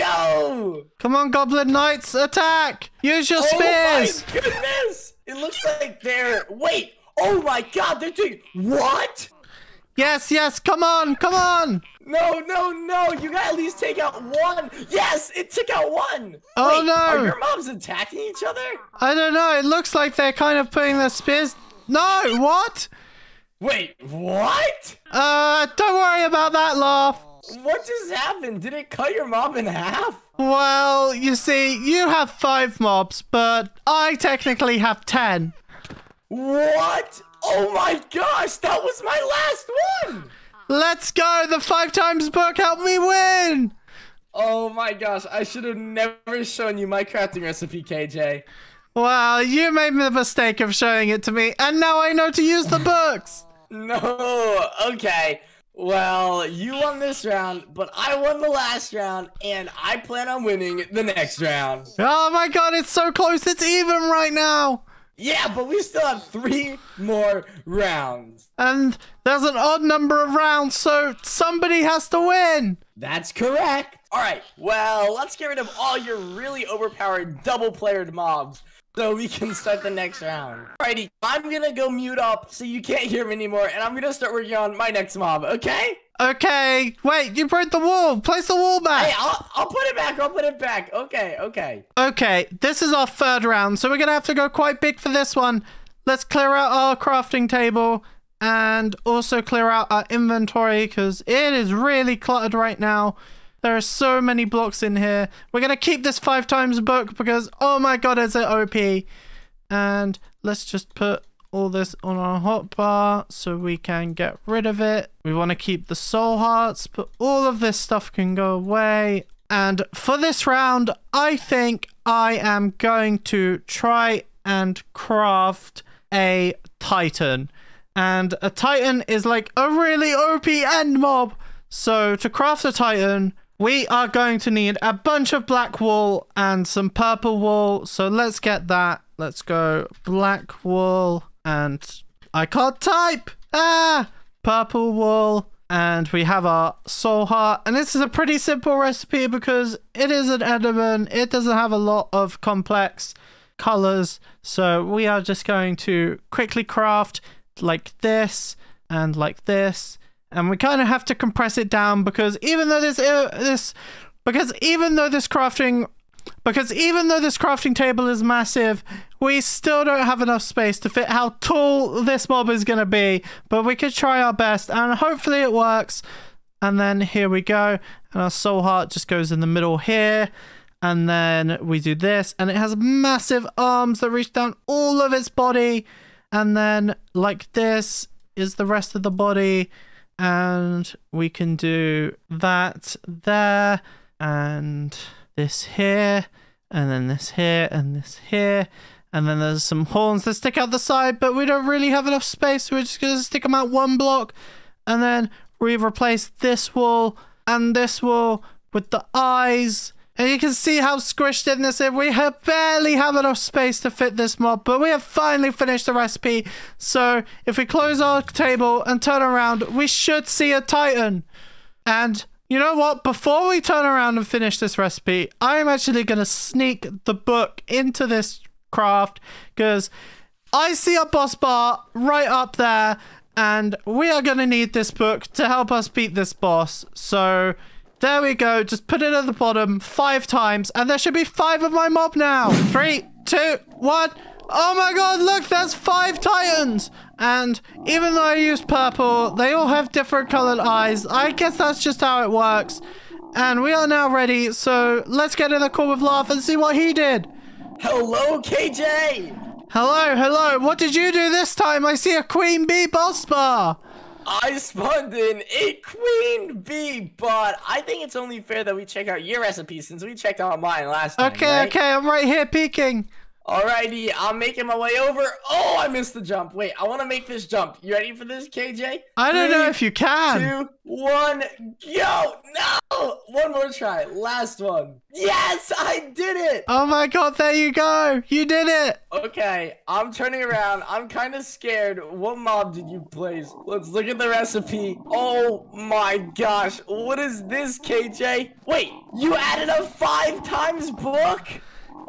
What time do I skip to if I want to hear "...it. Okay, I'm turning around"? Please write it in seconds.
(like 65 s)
288 s.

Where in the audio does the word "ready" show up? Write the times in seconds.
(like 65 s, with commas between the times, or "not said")
254 s, 277 s.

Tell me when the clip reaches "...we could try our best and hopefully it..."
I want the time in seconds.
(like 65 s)
173 s.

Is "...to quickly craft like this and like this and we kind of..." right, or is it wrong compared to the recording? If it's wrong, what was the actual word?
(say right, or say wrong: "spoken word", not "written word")
right.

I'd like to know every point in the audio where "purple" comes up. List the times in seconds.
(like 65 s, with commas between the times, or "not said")
136 s, 144 s, 248 s.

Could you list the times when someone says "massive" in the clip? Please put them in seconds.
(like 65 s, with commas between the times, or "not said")
168 s, 182 s.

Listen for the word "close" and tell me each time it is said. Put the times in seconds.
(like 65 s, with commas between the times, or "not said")
63 s, 217 s.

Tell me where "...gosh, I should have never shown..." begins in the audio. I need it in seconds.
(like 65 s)
44 s.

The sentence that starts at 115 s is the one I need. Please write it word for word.
We want to keep the soul hearts, but all of this stuff can go away.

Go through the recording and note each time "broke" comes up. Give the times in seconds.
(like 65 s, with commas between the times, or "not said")
87 s.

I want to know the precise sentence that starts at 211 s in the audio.
We have barely have enough space to fit this mob, but we have finally finished the recipe.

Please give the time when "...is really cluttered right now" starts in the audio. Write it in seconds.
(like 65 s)
101 s.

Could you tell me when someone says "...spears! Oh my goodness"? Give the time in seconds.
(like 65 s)
4 s.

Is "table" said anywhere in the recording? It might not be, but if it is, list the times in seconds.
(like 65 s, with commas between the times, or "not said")
97 s, 167 s, 218 s.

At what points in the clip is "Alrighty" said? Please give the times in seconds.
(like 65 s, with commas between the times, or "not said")
80 s, 273 s.